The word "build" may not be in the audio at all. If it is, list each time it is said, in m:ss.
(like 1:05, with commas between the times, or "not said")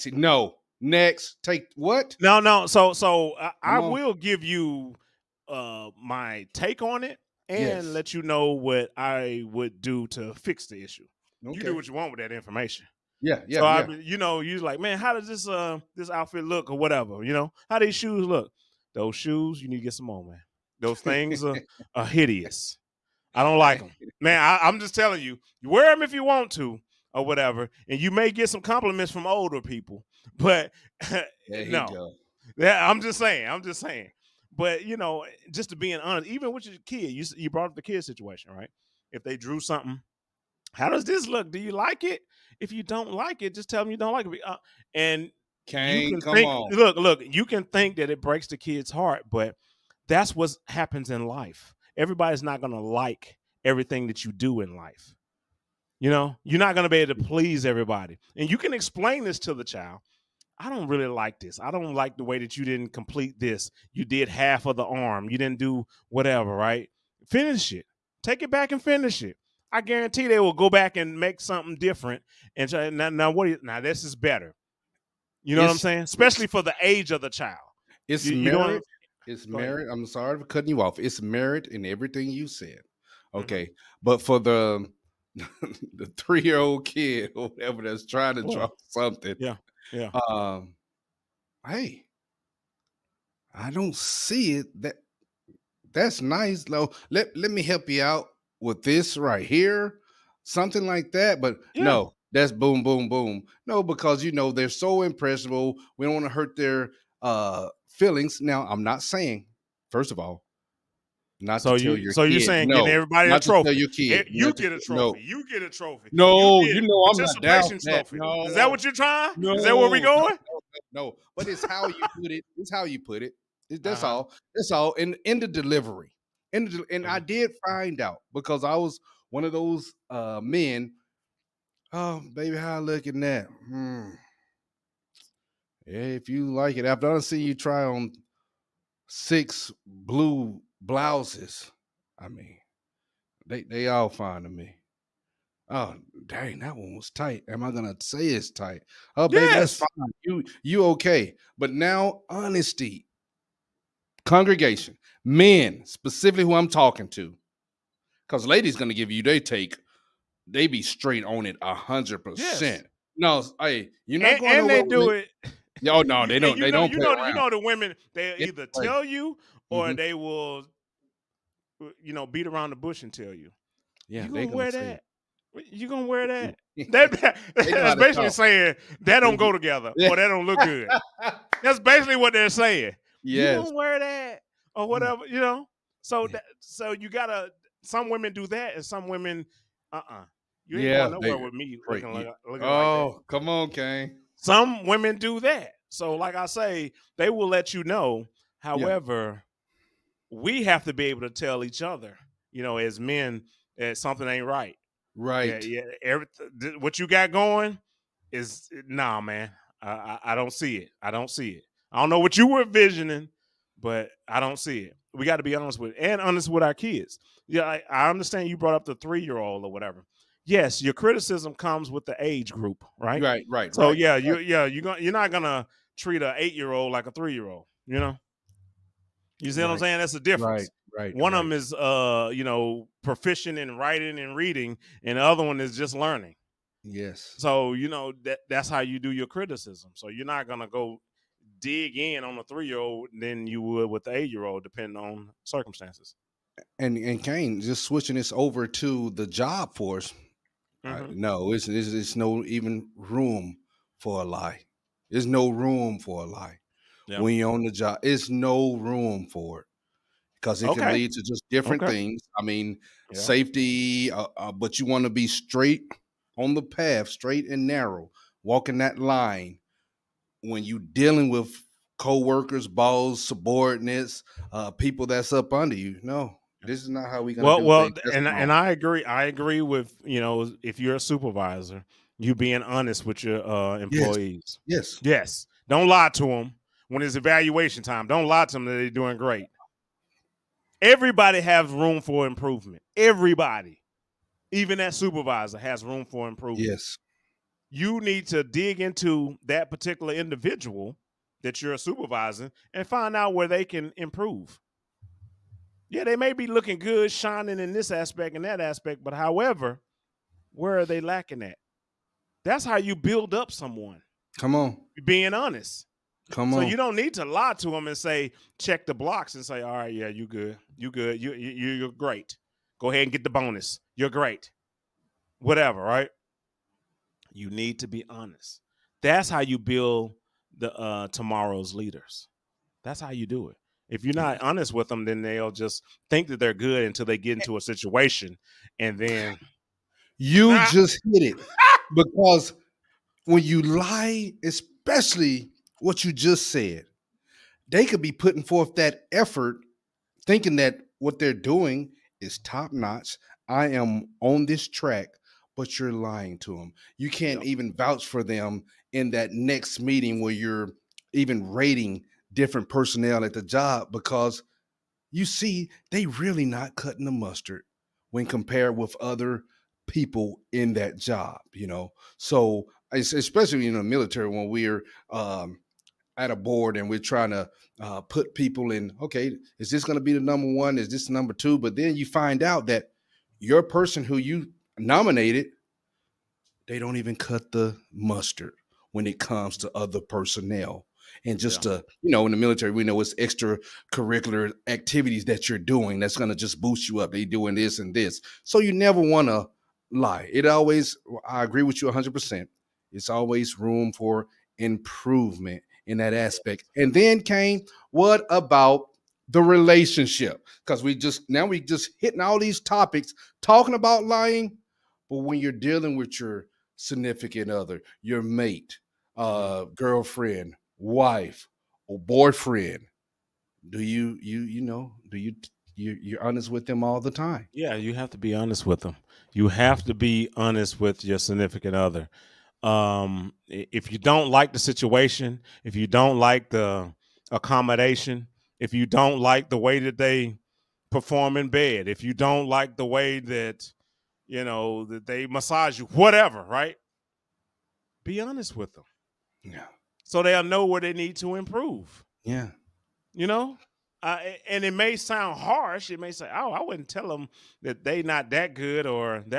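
5:12, 5:29.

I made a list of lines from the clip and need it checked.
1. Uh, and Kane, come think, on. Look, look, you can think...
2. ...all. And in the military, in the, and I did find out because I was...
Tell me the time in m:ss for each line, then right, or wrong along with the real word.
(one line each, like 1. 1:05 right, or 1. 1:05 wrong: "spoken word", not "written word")
1. 0:44 right
2. 2:04 wrong: "delivery", not "military".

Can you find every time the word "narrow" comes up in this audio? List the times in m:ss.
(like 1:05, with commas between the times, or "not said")
4:27.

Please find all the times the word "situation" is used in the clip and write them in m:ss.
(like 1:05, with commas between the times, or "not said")
0:38, 5:37, 7:14.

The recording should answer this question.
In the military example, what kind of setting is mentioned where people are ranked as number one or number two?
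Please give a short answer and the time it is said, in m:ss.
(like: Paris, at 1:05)
a board, at 6:16.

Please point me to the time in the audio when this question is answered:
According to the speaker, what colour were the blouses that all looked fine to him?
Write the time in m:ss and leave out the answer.
2:19.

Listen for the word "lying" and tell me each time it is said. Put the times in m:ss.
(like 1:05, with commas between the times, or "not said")
5:55, 6:54.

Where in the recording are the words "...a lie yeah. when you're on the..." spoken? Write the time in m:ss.
4:16.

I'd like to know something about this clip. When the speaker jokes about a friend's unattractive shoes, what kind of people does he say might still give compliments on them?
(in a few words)
older people.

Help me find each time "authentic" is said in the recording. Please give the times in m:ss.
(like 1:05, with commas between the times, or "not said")
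not said.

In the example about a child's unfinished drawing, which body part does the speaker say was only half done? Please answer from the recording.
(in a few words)
the arm.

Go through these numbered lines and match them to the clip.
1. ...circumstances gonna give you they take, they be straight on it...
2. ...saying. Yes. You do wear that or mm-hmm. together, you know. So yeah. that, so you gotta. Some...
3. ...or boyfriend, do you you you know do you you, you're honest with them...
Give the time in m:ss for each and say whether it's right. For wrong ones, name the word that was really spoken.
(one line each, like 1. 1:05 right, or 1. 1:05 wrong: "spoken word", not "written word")
1. 2:38 wrong: "ladies", not "circumstances"
2. 3:02 wrong: "whatever", not "together"
3. 7:01 right.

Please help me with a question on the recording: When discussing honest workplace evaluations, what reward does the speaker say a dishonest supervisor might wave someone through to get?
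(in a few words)
the bonus.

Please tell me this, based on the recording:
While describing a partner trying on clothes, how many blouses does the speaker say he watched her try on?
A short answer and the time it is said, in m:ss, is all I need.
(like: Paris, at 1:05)
6, at 2:19.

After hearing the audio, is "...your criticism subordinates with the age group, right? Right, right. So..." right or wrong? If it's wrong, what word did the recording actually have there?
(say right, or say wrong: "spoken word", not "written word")
wrong: "comes", not "subordinates".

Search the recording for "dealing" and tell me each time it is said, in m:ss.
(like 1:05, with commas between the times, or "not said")
4:30, 6:55.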